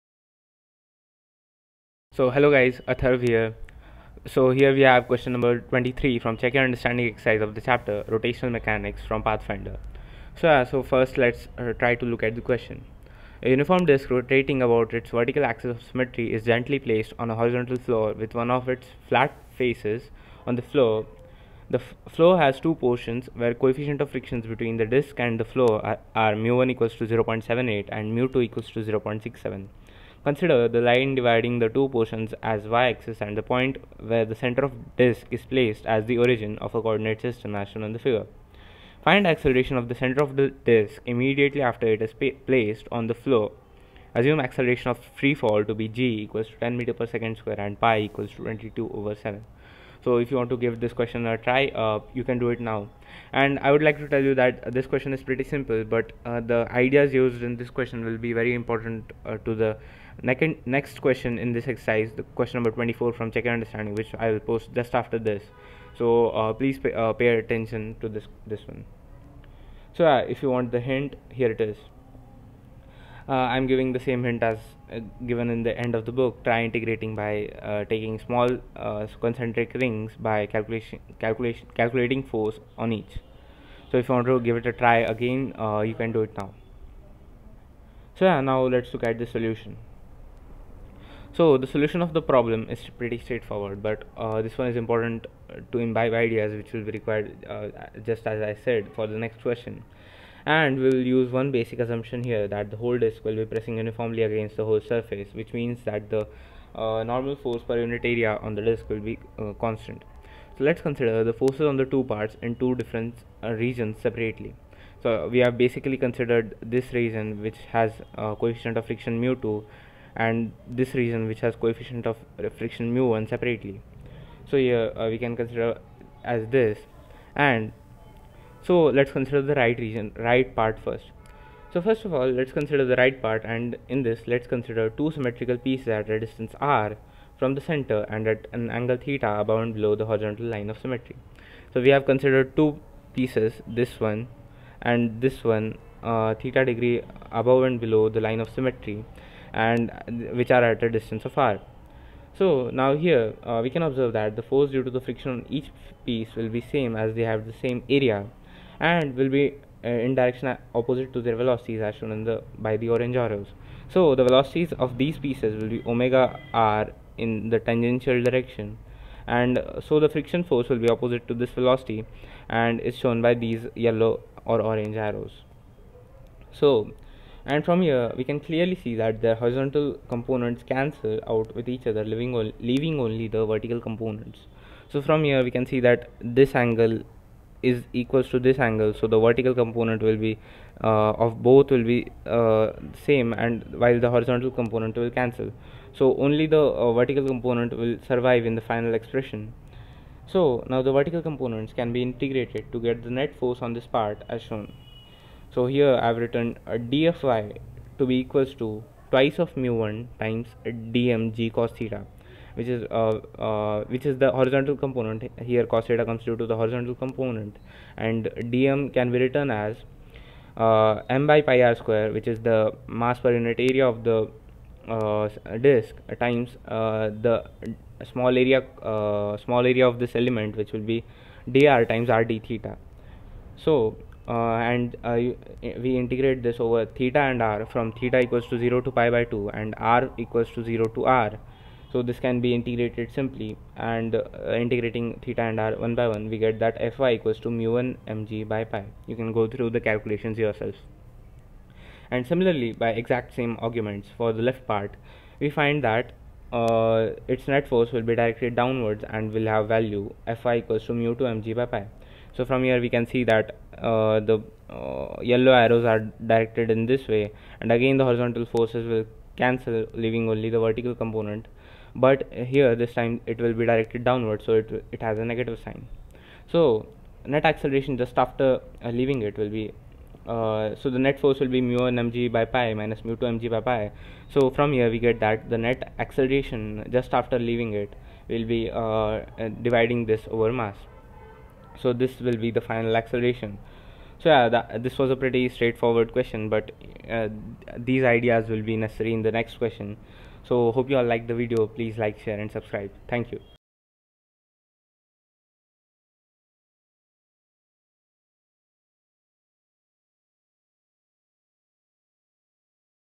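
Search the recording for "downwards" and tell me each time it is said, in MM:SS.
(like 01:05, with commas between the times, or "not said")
04:18, 04:34.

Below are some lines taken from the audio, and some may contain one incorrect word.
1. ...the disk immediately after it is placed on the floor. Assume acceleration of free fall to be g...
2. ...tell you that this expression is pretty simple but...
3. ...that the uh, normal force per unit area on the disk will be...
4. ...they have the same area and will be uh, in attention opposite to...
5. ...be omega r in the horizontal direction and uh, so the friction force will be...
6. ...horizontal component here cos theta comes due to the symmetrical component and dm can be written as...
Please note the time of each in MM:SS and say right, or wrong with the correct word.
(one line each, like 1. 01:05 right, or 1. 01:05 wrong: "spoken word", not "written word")
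1. 00:40 right
2. 00:54 wrong: "question", not "expression"
3. 01:45 right
4. 02:37 wrong: "direction", not "attention"
5. 02:45 wrong: "tangential", not "horizontal"
6. 03:34 wrong: "horizontal", not "symmetrical".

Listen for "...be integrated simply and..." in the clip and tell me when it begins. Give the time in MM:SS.
04:02.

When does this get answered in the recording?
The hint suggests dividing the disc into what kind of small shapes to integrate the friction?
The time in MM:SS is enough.
01:19.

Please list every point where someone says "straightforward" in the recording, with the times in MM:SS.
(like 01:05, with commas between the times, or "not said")
01:33, 04:55.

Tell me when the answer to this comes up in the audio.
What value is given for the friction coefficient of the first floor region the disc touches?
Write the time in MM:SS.
00:27.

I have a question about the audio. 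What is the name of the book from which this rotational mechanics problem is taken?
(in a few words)
Pathfinder.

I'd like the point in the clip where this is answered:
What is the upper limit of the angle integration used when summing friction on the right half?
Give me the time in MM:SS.
03:58.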